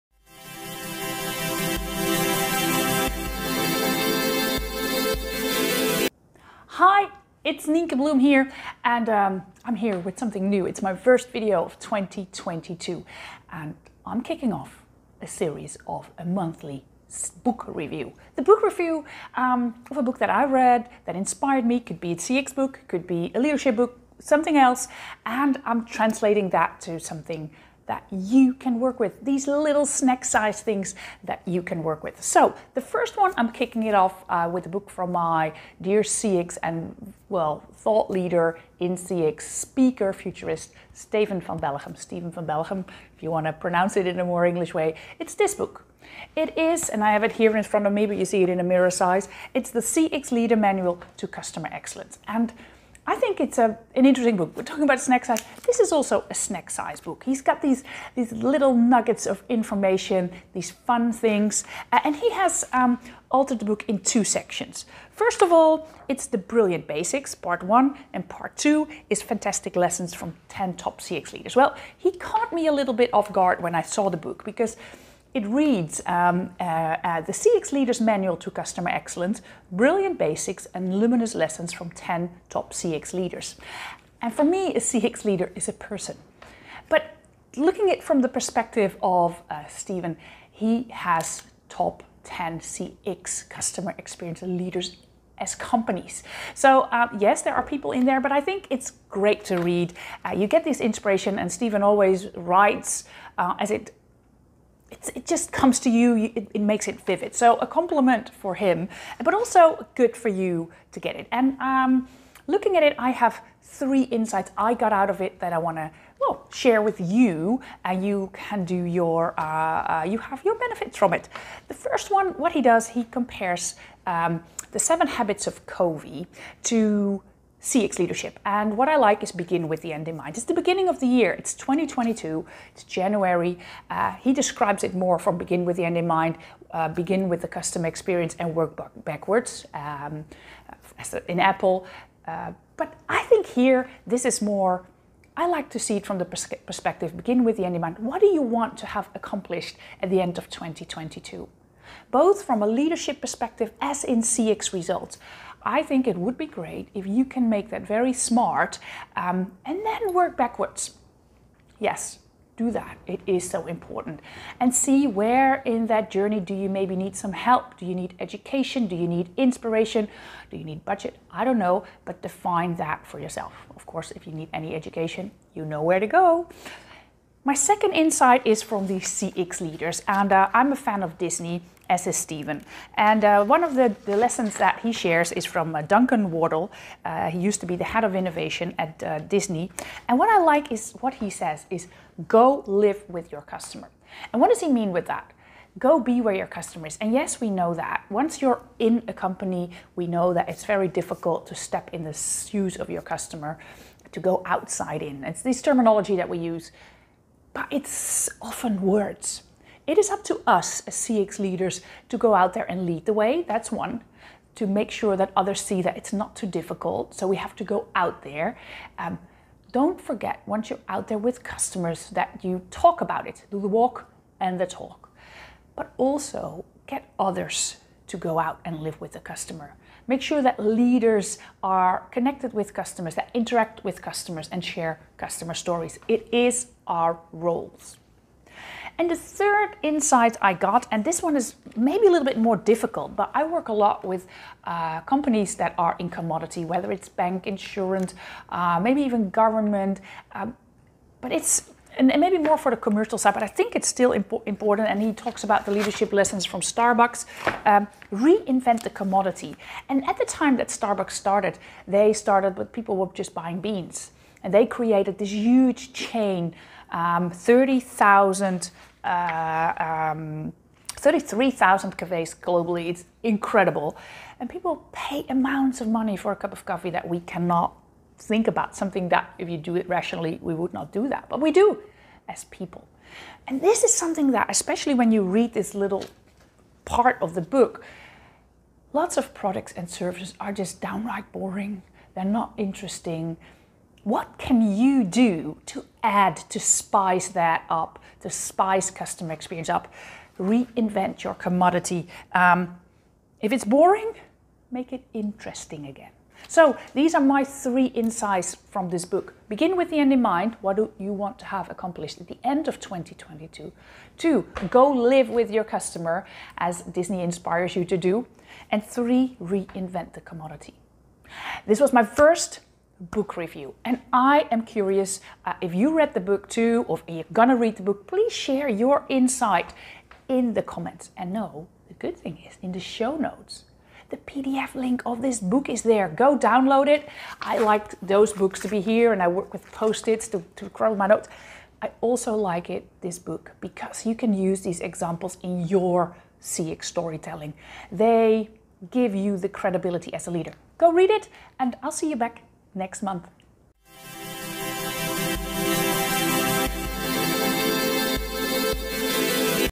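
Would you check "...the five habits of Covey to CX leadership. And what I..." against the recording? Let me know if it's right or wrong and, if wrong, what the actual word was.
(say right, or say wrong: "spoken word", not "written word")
wrong: "seven", not "five".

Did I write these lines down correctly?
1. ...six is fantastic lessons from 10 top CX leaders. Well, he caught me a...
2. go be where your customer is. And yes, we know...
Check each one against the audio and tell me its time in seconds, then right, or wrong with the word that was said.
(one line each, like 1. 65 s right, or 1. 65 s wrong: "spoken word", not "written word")
1. 68 s wrong: "two", not "six"
2. 195 s right.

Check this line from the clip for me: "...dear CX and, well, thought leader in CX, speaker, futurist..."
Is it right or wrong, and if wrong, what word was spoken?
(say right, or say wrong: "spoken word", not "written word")
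right.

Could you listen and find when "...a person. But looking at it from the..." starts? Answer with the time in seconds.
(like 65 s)
85 s.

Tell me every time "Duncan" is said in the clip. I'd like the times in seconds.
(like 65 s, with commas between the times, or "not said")
185 s.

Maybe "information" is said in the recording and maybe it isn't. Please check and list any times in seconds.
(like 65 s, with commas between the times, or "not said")
59 s.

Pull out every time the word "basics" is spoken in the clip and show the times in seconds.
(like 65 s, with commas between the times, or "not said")
66 s, 80 s.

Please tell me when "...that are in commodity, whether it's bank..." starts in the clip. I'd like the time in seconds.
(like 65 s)
245 s.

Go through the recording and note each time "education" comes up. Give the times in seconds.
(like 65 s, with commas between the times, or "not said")
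168 s, 174 s.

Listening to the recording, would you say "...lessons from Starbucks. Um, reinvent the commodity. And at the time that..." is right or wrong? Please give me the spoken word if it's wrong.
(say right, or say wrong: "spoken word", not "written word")
right.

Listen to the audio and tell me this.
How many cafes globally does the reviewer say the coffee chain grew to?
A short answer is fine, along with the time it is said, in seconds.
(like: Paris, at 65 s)
33,000, at 270 s.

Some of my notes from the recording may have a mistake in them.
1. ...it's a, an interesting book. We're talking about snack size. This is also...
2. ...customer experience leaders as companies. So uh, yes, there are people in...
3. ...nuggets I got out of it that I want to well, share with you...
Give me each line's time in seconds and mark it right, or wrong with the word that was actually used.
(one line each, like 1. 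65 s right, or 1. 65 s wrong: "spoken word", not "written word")
1. 53 s right
2. 93 s right
3. 114 s wrong: "insights", not "nuggets".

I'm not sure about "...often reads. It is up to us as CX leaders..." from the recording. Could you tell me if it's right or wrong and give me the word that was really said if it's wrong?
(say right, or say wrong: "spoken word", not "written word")
wrong: "words", not "reads".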